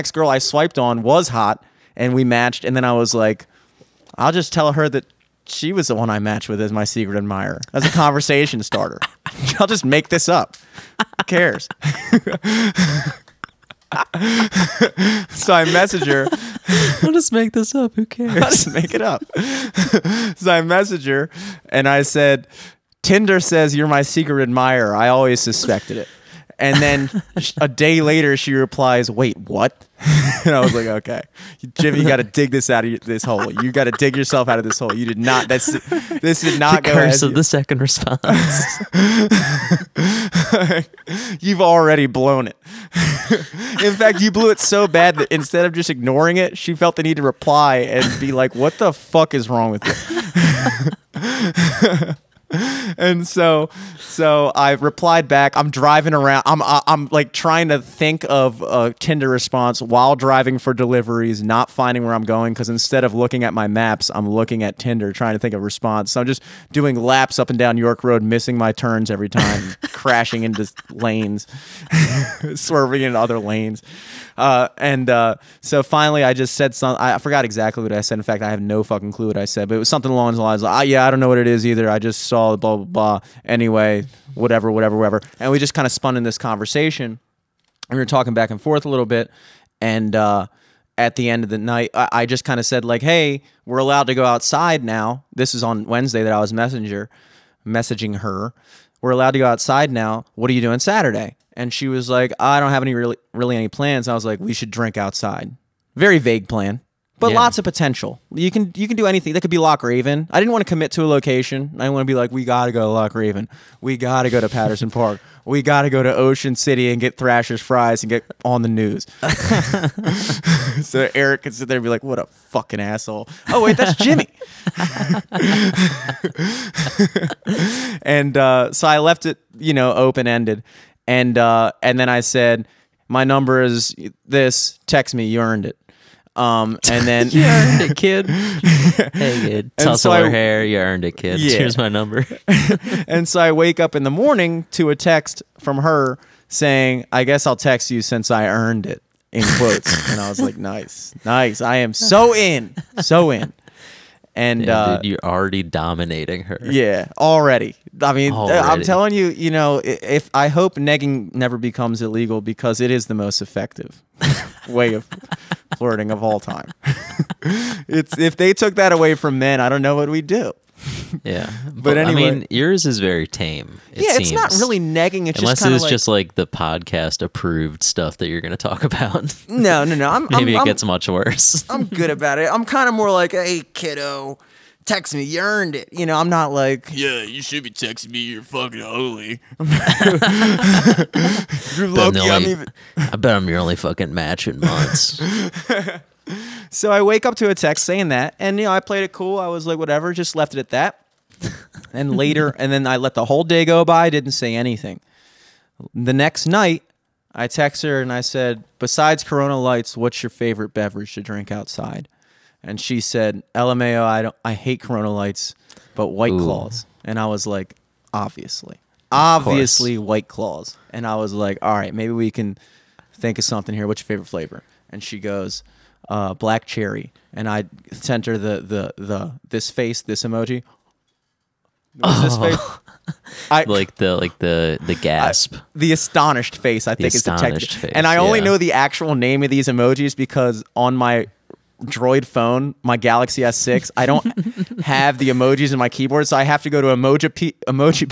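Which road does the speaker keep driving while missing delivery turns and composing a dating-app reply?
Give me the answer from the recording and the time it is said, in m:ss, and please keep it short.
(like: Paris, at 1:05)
York Road, at 1:07.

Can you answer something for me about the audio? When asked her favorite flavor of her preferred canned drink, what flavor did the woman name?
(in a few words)
Black cherry.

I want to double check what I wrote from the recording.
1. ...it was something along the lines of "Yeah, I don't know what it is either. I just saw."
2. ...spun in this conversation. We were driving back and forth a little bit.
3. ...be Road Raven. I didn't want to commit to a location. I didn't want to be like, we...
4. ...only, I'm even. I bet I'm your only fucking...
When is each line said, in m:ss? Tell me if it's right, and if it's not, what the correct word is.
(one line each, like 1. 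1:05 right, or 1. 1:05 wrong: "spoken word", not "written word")
1. 1:19 right
2. 1:25 wrong: "talking", not "driving"
3. 1:49 wrong: "Loch", not "Road"
4. 3:12 right.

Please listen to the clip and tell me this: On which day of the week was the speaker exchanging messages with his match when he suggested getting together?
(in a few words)
Wednesday.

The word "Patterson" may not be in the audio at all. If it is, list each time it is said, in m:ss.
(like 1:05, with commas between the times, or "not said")
1:54.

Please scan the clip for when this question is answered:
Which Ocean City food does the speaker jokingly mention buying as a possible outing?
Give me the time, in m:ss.
1:57.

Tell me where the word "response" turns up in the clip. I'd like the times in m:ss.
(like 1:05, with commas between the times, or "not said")
0:37, 0:59, 1:05.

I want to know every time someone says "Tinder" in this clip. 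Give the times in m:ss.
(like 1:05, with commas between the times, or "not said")
0:23, 0:58, 1:04.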